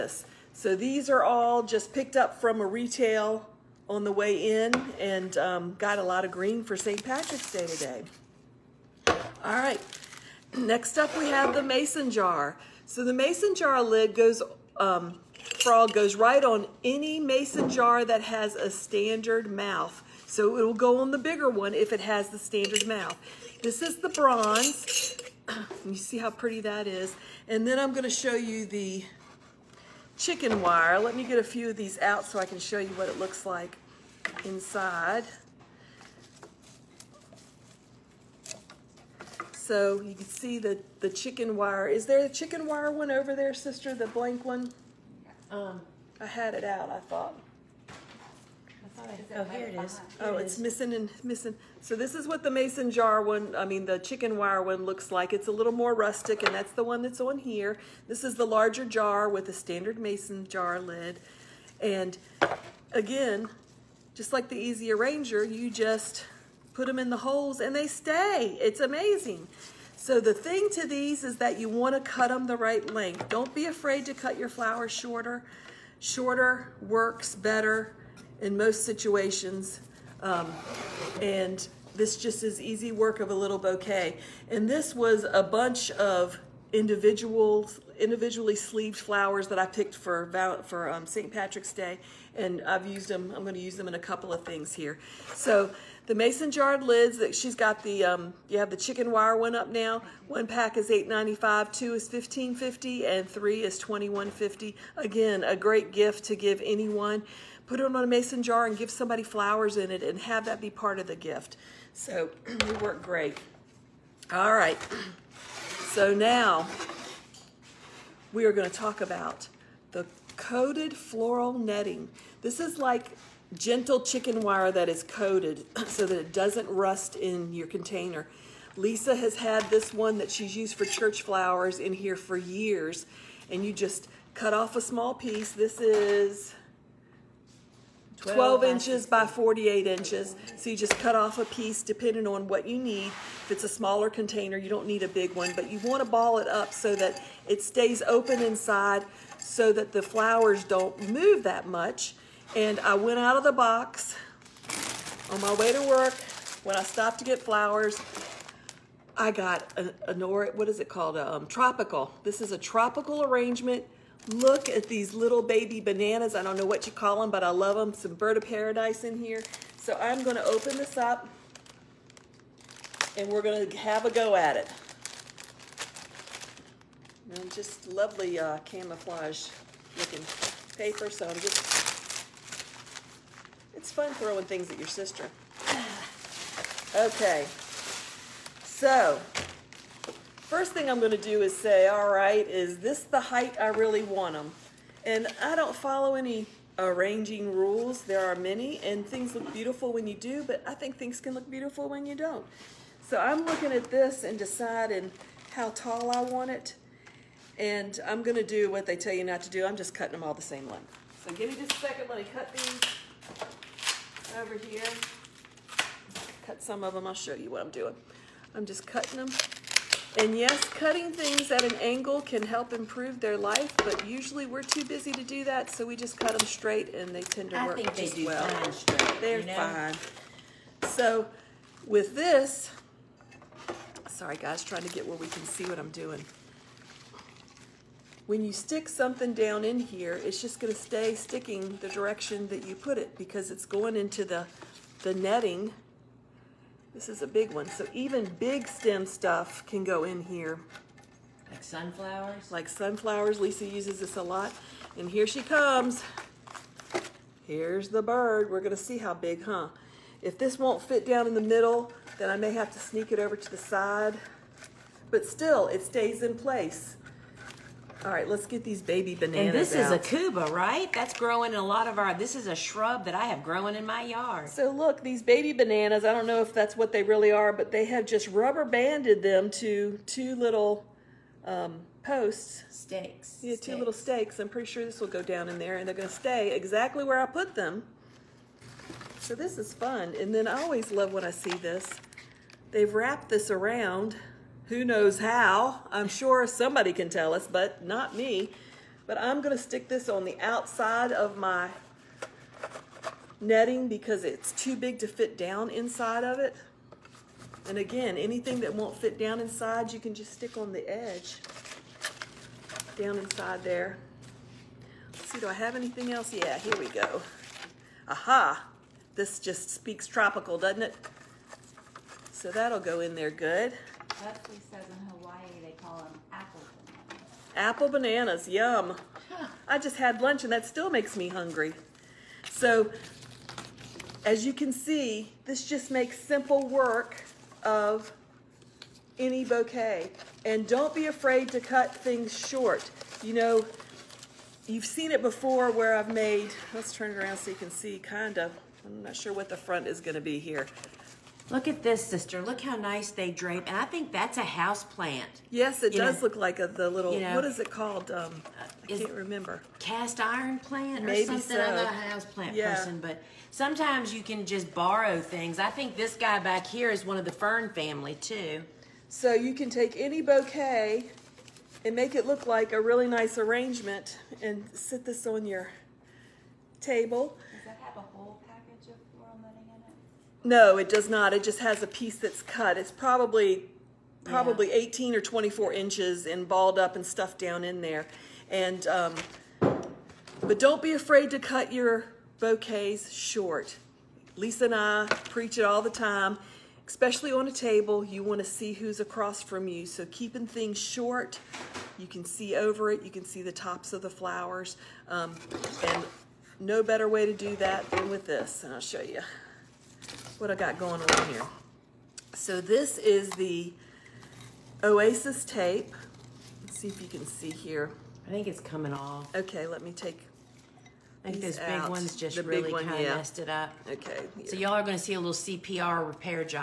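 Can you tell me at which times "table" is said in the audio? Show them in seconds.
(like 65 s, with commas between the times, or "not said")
376 s, 397 s.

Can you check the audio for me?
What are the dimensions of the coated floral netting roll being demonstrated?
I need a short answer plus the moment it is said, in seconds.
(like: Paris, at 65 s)
12 inches by 48 inches, at 138 s.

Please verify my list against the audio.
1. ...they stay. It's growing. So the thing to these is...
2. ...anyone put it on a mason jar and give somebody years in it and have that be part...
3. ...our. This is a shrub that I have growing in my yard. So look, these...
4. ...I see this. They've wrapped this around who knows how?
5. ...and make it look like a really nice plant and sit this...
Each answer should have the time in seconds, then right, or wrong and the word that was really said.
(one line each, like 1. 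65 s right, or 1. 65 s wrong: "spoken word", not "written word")
1. 67 s wrong: "amazing", not "growing"
2. 106 s wrong: "flowers", not "years"
3. 271 s right
4. 291 s right
5. 371 s wrong: "arrangement", not "plant".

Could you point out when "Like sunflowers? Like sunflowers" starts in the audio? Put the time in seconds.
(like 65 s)
251 s.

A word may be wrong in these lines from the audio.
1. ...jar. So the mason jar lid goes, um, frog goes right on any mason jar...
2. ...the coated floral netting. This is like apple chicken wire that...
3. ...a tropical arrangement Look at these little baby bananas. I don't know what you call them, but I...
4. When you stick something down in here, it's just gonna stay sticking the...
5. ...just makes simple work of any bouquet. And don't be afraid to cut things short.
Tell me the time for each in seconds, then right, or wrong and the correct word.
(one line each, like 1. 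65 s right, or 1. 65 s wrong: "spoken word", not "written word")
1. 12 s right
2. 119 s wrong: "gentle", not "apple"
3. 162 s right
4. 238 s right
5. 335 s right.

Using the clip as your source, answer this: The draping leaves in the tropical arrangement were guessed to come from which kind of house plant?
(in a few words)
Cast iron plant.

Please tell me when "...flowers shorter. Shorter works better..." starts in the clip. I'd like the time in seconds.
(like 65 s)
74 s.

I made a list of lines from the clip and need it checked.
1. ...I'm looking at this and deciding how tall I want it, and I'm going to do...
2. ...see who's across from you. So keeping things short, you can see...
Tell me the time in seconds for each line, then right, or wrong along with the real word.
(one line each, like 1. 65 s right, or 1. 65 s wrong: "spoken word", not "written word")
1. 203 s right
2. 398 s right.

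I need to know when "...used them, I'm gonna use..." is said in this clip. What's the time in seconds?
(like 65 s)
92 s.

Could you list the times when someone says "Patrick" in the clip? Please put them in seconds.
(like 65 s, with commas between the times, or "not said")
7 s, 91 s.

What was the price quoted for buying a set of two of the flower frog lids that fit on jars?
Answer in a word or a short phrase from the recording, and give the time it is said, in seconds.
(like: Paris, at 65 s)
$15.50, at 101 s.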